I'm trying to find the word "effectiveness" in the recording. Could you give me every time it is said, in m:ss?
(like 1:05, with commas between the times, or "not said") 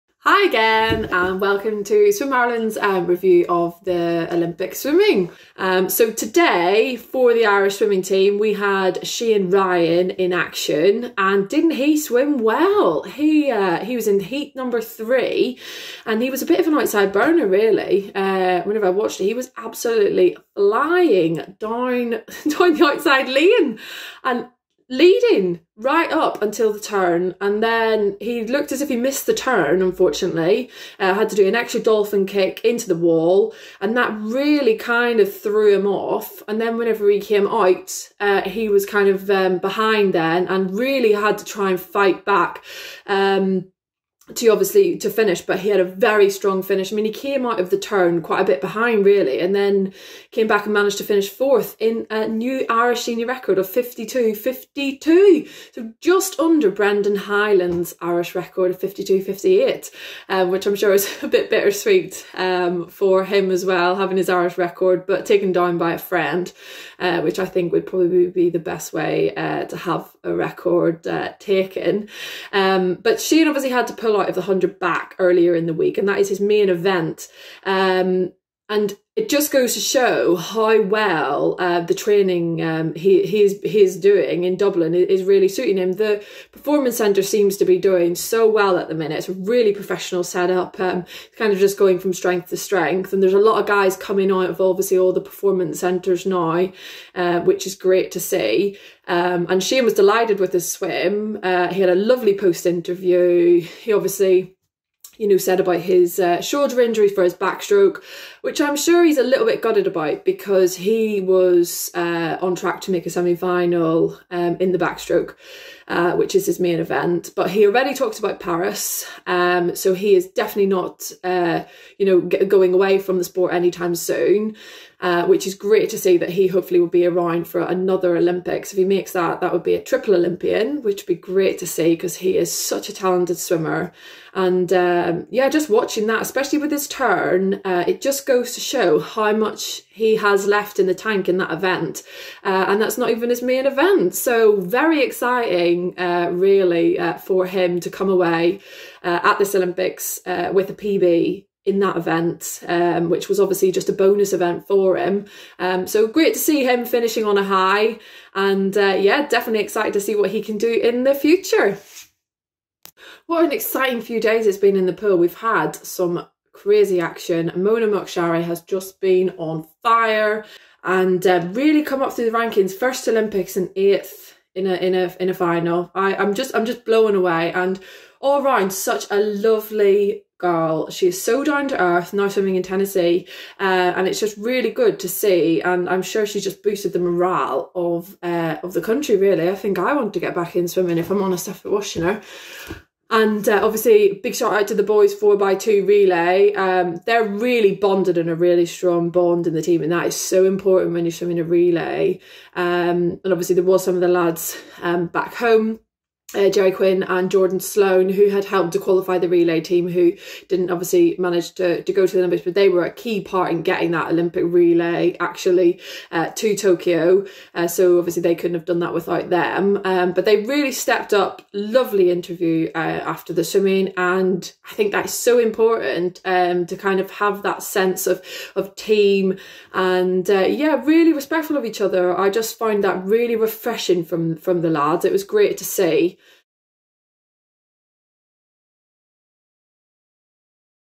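not said.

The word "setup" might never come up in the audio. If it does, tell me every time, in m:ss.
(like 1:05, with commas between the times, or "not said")
1:30.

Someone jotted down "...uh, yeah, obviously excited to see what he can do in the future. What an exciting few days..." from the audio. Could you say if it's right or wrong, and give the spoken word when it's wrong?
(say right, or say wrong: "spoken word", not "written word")
wrong: "definitely", not "obviously".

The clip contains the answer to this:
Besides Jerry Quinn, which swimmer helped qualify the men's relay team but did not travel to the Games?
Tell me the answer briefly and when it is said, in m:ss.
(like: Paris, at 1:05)
Jordan Sloan, at 3:27.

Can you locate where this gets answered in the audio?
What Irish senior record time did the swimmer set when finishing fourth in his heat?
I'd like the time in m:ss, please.
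0:53.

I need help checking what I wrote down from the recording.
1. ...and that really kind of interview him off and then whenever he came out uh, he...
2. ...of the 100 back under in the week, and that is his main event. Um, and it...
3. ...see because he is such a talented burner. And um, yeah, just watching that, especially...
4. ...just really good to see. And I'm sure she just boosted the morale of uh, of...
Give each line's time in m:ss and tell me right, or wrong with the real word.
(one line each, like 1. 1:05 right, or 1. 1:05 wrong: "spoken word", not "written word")
1. 0:33 wrong: "threw", not "interview"
2. 1:14 wrong: "earlier", not "under"
3. 2:11 wrong: "swimmer", not "burner"
4. 3:04 right.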